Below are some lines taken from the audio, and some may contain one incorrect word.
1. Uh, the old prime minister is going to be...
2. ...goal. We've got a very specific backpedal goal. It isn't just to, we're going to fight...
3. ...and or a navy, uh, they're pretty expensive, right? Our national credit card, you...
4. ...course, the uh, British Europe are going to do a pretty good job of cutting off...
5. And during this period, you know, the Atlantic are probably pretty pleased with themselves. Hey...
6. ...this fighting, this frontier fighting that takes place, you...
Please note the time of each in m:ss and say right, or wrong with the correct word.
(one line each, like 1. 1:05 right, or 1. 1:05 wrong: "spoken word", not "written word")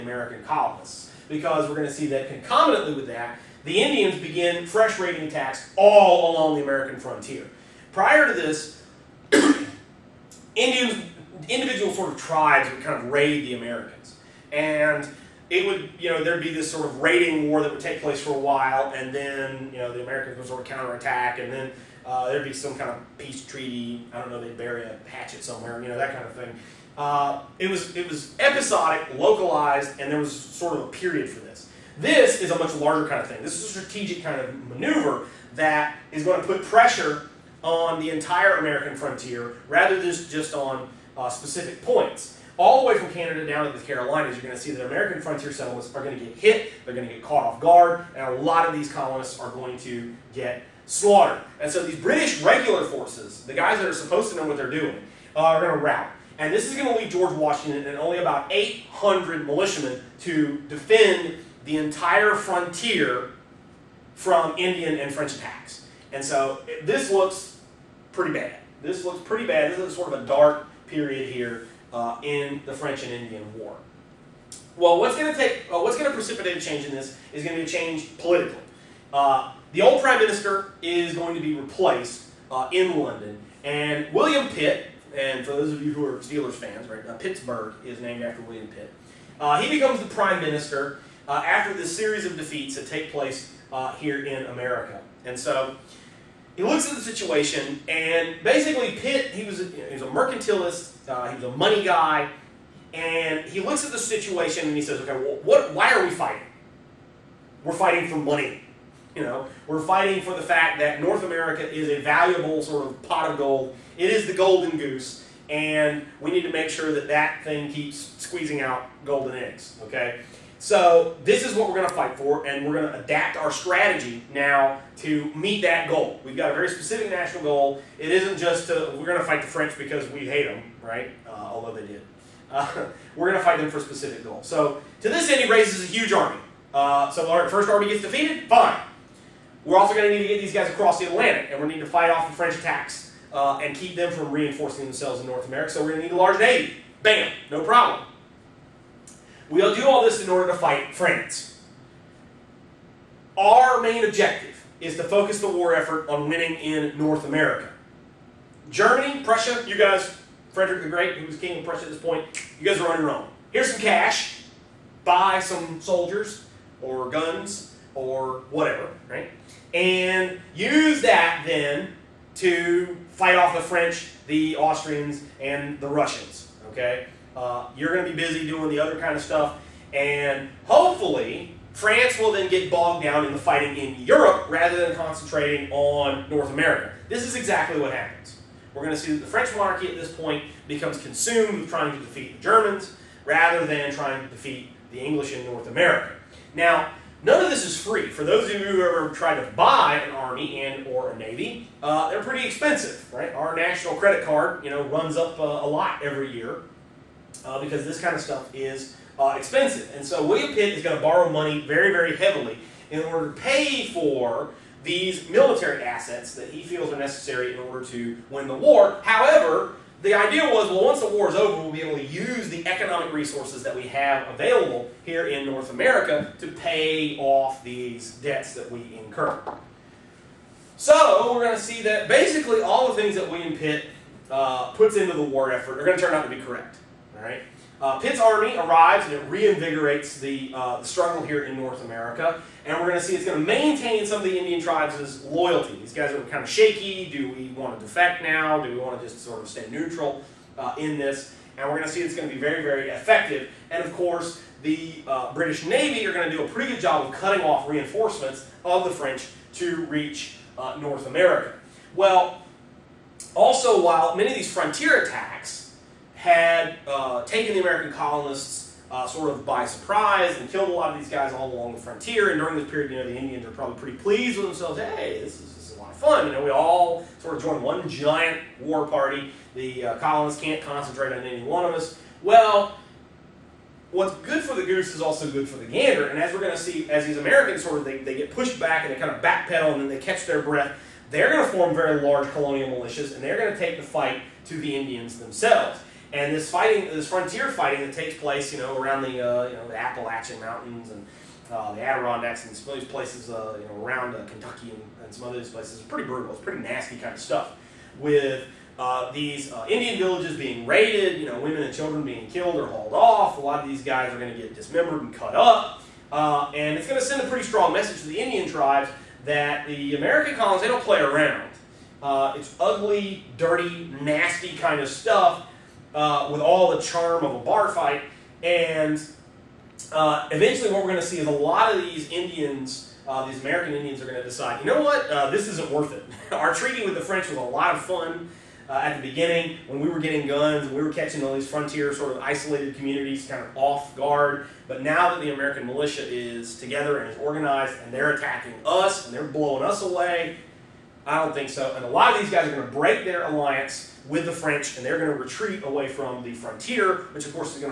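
1. 1:19 right
2. 2:05 wrong: "national", not "backpedal"
3. 3:20 right
4. 4:13 wrong: "Navy", not "Europe"
5. 4:32 wrong: "Indians", not "Atlantic"
6. 4:56 right.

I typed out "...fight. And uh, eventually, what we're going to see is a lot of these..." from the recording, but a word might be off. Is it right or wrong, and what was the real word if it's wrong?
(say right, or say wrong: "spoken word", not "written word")
right.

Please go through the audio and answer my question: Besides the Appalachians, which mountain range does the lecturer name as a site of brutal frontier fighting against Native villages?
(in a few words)
Adirondacks.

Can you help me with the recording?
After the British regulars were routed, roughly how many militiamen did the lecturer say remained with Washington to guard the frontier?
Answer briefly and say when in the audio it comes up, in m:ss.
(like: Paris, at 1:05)
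800, at 0:58.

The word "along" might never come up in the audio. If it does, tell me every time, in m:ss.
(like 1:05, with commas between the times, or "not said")
0:06, 4:31.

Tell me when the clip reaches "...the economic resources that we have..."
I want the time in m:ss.
3:42.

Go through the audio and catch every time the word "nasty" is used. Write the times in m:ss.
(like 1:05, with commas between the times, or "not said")
5:06, 5:23.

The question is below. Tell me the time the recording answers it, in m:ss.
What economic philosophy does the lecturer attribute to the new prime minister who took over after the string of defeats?
1:40.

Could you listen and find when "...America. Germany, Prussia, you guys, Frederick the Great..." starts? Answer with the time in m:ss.
2:37.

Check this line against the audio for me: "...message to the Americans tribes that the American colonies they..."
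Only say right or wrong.
wrong.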